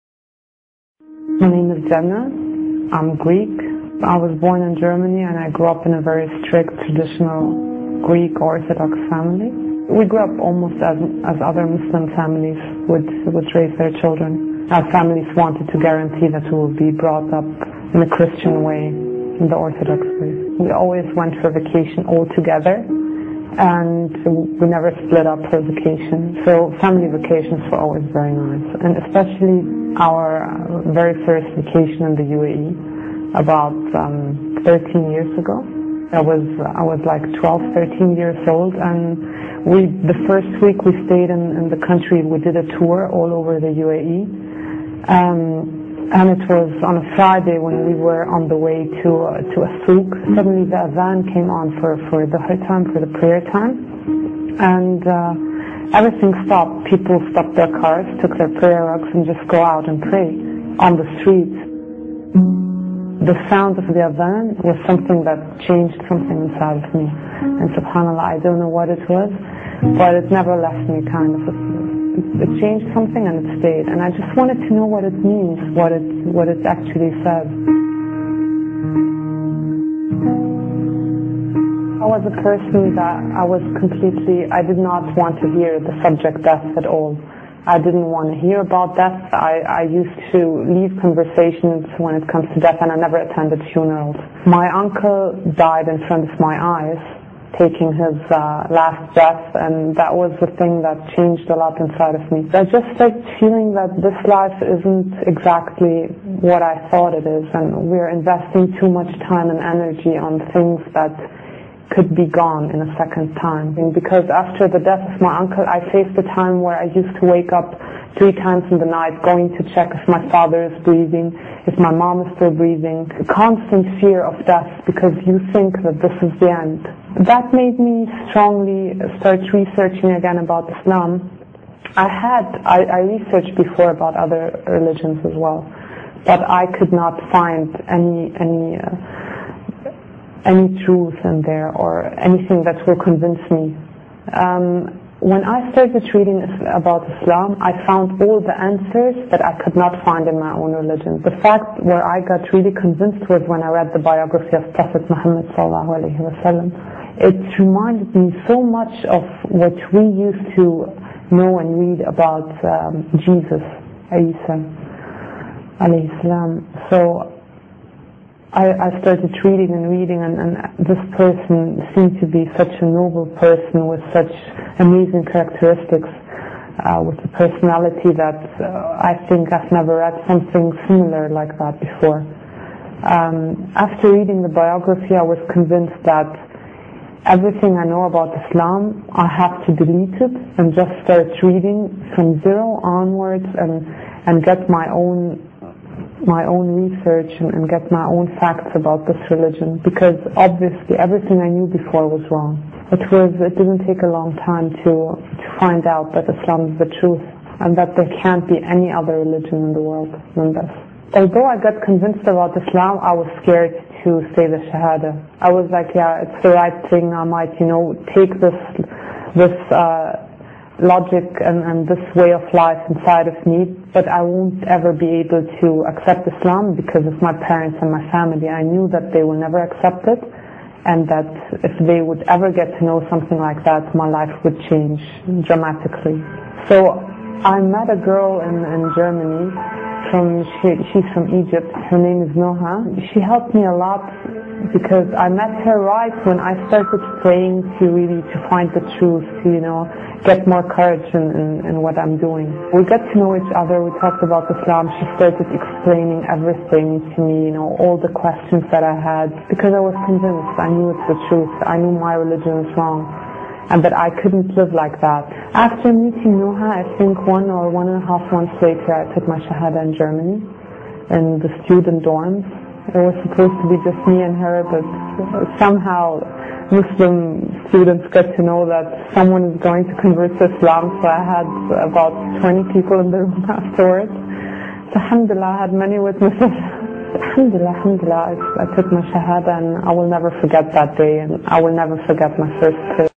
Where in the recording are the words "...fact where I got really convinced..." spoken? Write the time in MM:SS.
02:31.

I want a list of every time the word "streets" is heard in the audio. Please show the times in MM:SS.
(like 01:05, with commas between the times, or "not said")
01:01.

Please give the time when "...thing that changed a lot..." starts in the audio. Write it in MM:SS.
01:40.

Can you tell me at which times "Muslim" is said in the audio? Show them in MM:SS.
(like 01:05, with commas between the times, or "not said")
00:11, 04:36.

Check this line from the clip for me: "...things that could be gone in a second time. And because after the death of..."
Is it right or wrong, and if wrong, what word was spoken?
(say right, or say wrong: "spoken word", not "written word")
right.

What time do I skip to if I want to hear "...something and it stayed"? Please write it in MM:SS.
01:12.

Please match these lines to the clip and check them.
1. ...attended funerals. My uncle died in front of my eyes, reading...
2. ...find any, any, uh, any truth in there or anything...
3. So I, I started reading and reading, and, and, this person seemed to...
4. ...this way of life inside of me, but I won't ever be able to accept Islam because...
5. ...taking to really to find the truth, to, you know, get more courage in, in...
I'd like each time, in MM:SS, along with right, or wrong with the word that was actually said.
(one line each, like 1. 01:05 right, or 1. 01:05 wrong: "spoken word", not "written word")
1. 01:33 wrong: "taking", not "reading"
2. 02:17 right
3. 02:46 right
4. 03:41 right
5. 04:07 wrong: "praying", not "taking".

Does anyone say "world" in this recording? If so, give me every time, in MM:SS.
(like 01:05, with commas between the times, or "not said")
03:29.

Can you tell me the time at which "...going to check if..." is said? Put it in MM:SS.
01:59.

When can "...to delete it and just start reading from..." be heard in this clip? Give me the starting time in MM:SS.
03:09.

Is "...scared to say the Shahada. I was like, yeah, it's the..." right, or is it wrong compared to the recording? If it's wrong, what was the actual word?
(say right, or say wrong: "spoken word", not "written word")
right.